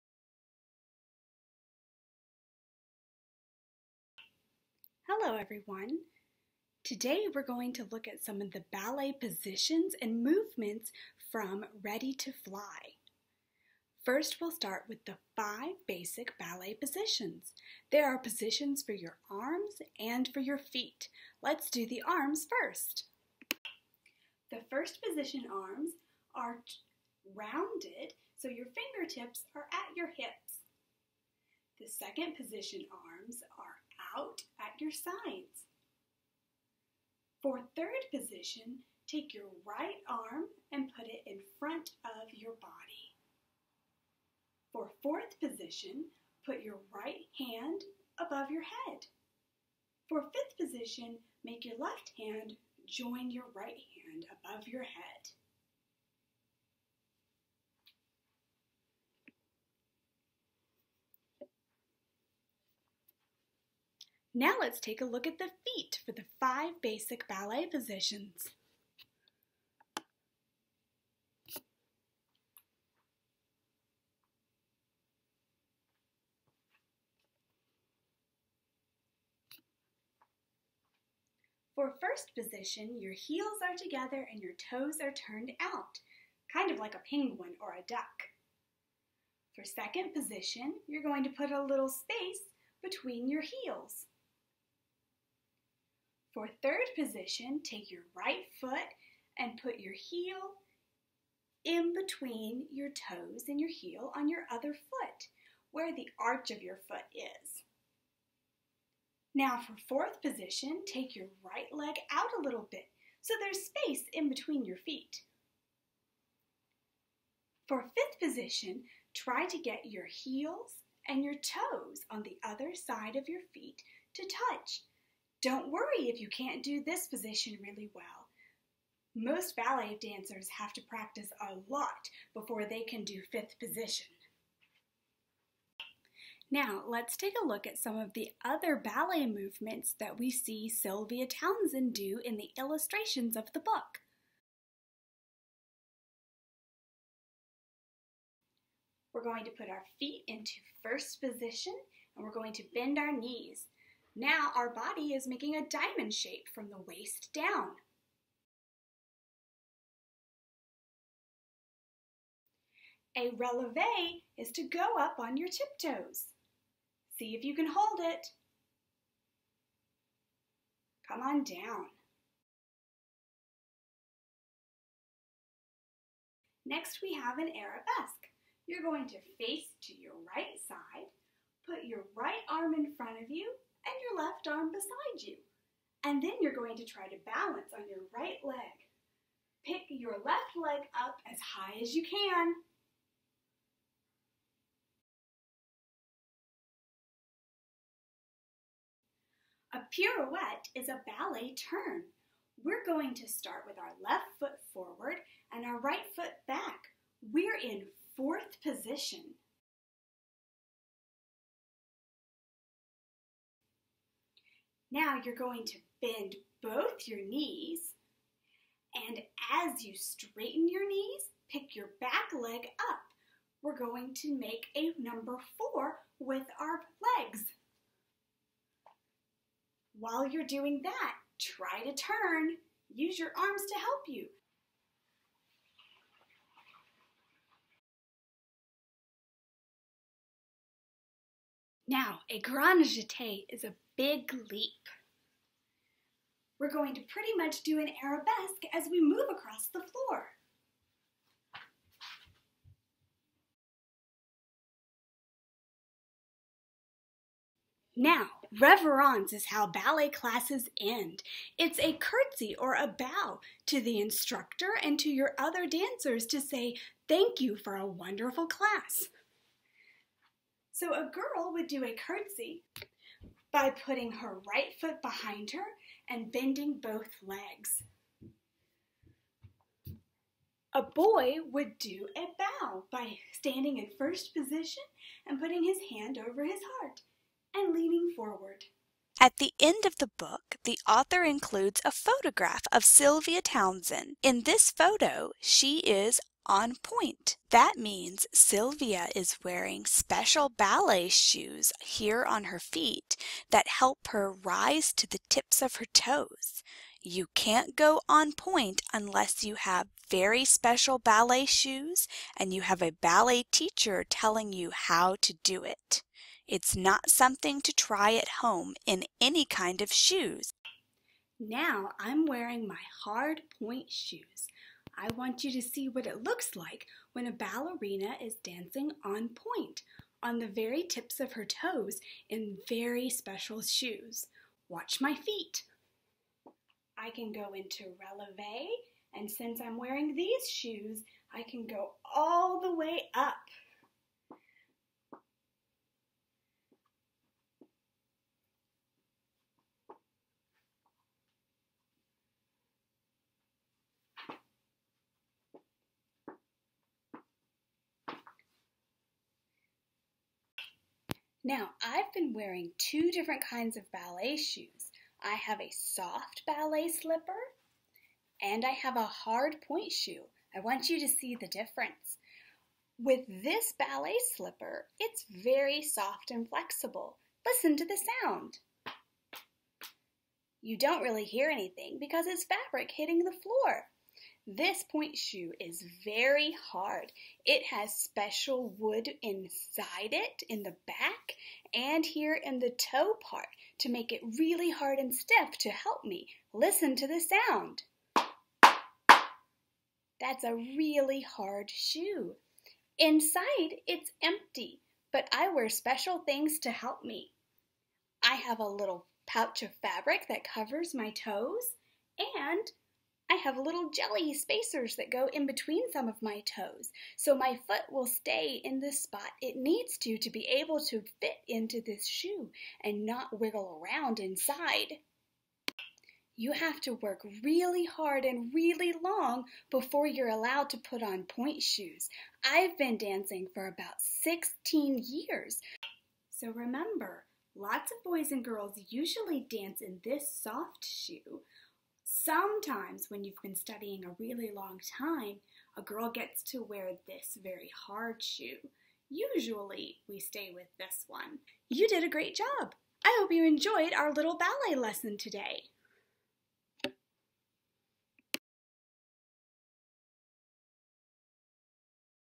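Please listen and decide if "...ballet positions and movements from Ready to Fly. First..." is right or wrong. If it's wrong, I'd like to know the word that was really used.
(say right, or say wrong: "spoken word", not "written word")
right.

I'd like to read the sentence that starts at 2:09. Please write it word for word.
Most ballet dancers have to practice a lot before they can do fifth position.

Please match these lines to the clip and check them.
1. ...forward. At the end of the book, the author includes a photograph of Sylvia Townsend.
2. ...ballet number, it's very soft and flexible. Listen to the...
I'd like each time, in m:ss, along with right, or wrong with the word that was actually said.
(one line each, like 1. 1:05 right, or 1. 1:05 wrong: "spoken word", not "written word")
1. 4:48 right
2. 6:13 wrong: "slipper", not "number".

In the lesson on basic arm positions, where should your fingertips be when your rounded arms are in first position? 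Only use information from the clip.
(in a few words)
At your hips.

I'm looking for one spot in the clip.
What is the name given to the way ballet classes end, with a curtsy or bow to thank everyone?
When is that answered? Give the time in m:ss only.
4:18.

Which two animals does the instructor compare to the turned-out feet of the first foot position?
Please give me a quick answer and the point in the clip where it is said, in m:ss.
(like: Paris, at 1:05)
A penguin or a duck, at 1:26.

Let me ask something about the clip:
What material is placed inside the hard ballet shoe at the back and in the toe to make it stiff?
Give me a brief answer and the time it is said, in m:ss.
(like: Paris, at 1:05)
Wood, at 6:28.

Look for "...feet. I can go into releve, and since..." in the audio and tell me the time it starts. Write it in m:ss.
5:35.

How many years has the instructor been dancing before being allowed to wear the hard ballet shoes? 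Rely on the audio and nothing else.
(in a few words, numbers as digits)
16.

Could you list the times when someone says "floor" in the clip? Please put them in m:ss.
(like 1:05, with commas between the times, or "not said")
4:09, 6:23.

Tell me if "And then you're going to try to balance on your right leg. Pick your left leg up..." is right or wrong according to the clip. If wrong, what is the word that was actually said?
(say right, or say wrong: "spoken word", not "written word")
right.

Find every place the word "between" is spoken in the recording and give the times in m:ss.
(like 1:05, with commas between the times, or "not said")
1:32, 1:41, 1:54, 6:55.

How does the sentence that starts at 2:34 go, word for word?
Now our body is making a diamond shape from the waist down.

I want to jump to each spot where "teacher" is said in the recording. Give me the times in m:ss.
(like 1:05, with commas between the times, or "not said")
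5:13.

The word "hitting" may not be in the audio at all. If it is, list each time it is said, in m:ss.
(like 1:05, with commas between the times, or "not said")
6:22.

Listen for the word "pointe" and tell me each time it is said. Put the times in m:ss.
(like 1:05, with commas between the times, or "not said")
4:56, 5:08, 5:23, 5:29, 6:09, 6:24, 7:11.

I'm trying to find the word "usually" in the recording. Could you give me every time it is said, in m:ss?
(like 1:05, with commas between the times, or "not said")
7:18, 7:29.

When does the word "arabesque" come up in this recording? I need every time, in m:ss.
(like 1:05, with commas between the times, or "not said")
2:57, 4:08.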